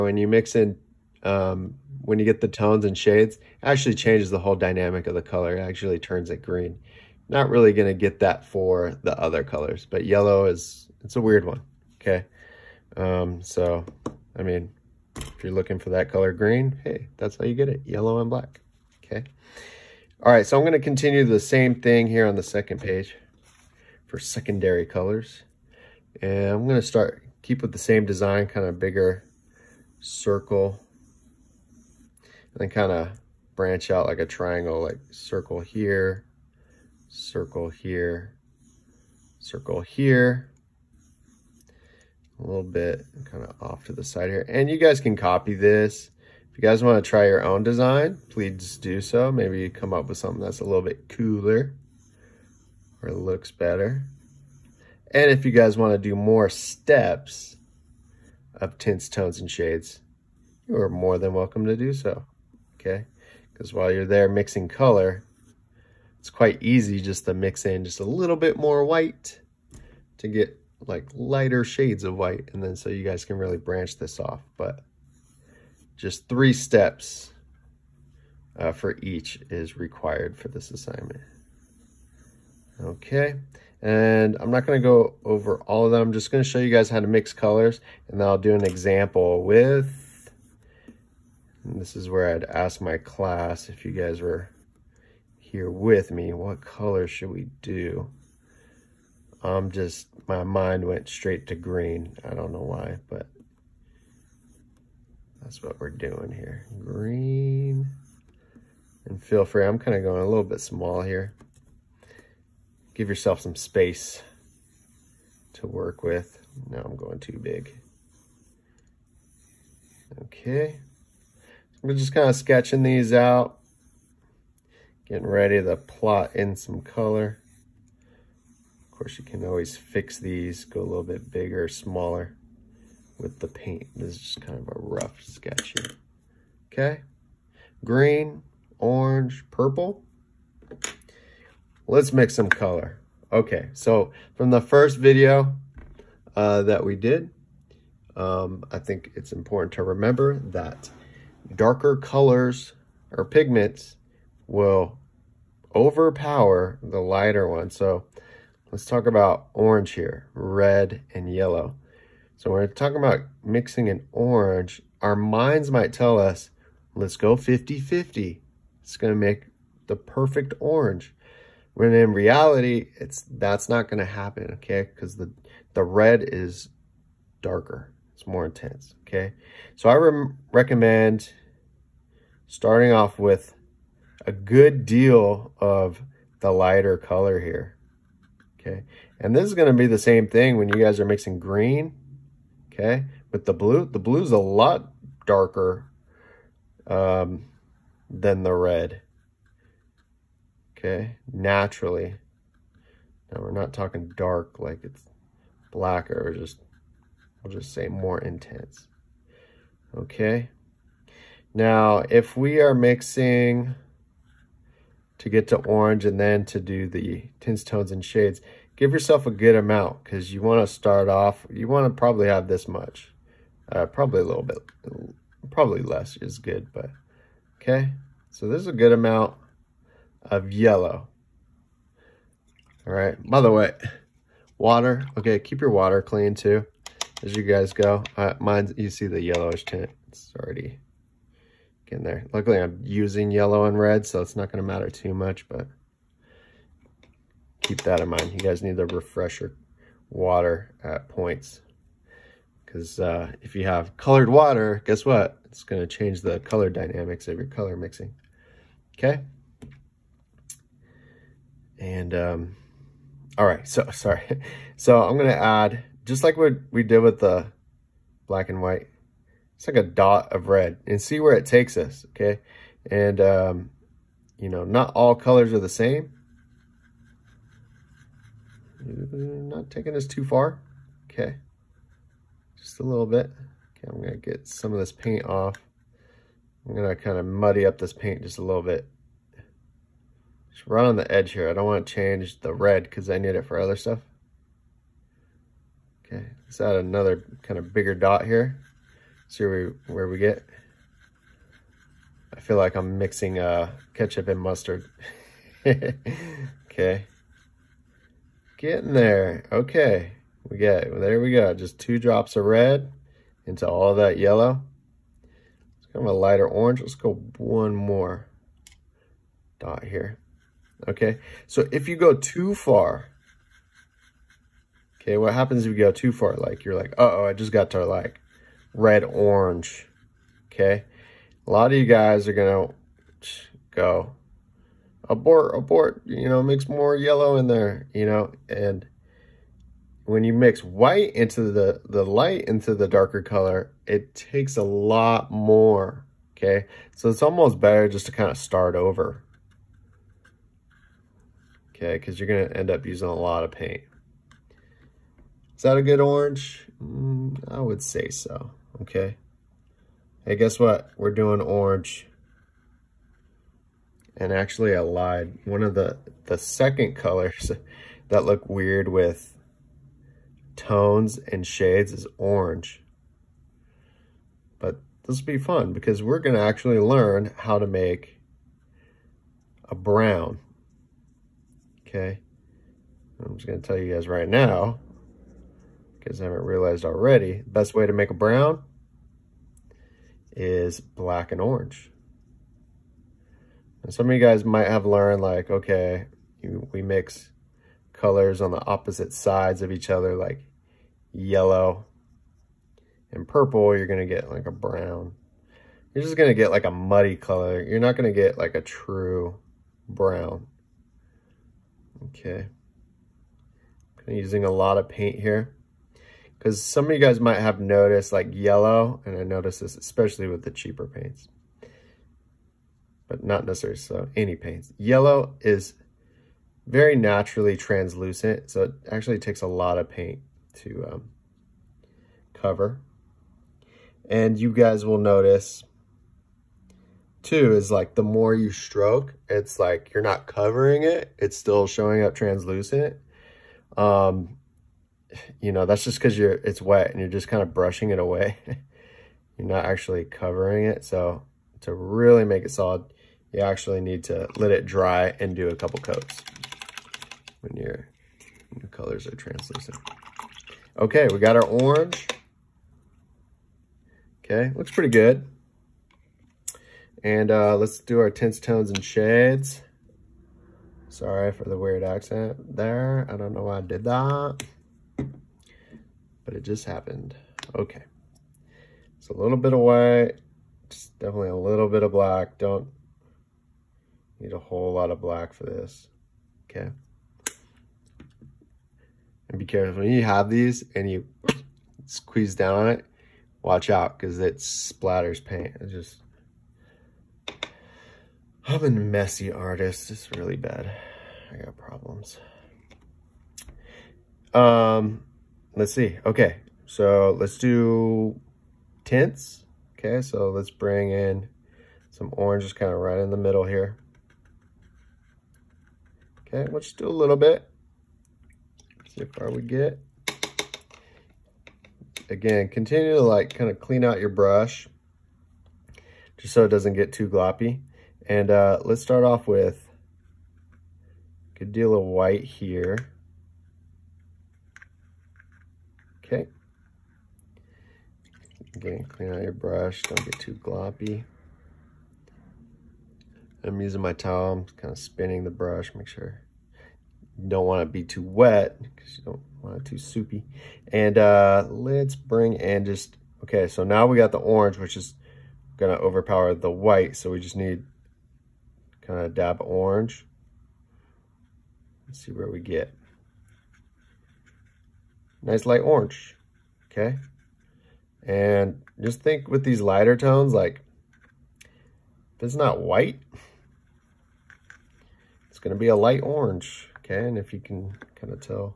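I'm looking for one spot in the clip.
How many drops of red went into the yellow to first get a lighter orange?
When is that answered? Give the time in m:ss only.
5:11.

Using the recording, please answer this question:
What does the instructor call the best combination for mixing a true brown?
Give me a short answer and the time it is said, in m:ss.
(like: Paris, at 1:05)
black and orange, at 6:30.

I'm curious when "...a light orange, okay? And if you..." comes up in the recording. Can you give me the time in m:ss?
9:35.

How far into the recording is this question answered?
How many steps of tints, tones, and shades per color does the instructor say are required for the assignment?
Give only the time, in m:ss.
1:16.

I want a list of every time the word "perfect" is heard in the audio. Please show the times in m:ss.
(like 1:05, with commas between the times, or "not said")
2:49.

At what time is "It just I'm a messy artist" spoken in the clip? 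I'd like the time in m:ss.
8:15.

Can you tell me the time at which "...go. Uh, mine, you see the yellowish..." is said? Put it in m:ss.
3:57.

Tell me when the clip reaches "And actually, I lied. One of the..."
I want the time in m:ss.
6:04.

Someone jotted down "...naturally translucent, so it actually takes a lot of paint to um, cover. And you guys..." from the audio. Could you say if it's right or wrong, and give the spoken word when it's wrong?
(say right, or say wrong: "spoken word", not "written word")
right.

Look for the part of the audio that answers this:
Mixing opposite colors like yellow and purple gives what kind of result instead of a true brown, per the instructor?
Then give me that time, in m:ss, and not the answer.
6:46.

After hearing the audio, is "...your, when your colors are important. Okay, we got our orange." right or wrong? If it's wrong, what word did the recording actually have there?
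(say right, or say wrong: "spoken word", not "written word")
wrong: "translucent", not "important".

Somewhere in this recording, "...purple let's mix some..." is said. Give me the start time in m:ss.
2:19.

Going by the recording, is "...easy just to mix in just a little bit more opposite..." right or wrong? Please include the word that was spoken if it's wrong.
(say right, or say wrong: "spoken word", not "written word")
wrong: "white", not "opposite".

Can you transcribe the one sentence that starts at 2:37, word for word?
So let's talk about orange here, red and yellow.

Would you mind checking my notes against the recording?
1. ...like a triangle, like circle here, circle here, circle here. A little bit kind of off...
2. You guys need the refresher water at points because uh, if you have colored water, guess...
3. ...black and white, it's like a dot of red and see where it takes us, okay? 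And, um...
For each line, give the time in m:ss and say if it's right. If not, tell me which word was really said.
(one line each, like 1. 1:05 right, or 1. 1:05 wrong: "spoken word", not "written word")
1. 0:34 right
2. 4:08 right
3. 4:28 right.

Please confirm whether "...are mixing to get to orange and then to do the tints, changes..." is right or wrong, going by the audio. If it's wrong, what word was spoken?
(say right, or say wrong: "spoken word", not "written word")
wrong: "tones", not "changes".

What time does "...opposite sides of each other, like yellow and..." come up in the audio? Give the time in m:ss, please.
6:38.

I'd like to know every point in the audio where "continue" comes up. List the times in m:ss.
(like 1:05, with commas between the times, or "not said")
0:20, 8:42.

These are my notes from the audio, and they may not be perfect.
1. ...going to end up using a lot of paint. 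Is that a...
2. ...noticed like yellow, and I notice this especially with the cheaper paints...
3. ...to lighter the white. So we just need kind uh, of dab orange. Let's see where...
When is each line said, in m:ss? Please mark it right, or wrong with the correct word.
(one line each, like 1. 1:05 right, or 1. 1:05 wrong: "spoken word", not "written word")
1. 5:52 right
2. 6:57 right
3. 9:15 wrong: "overpower", not "lighter".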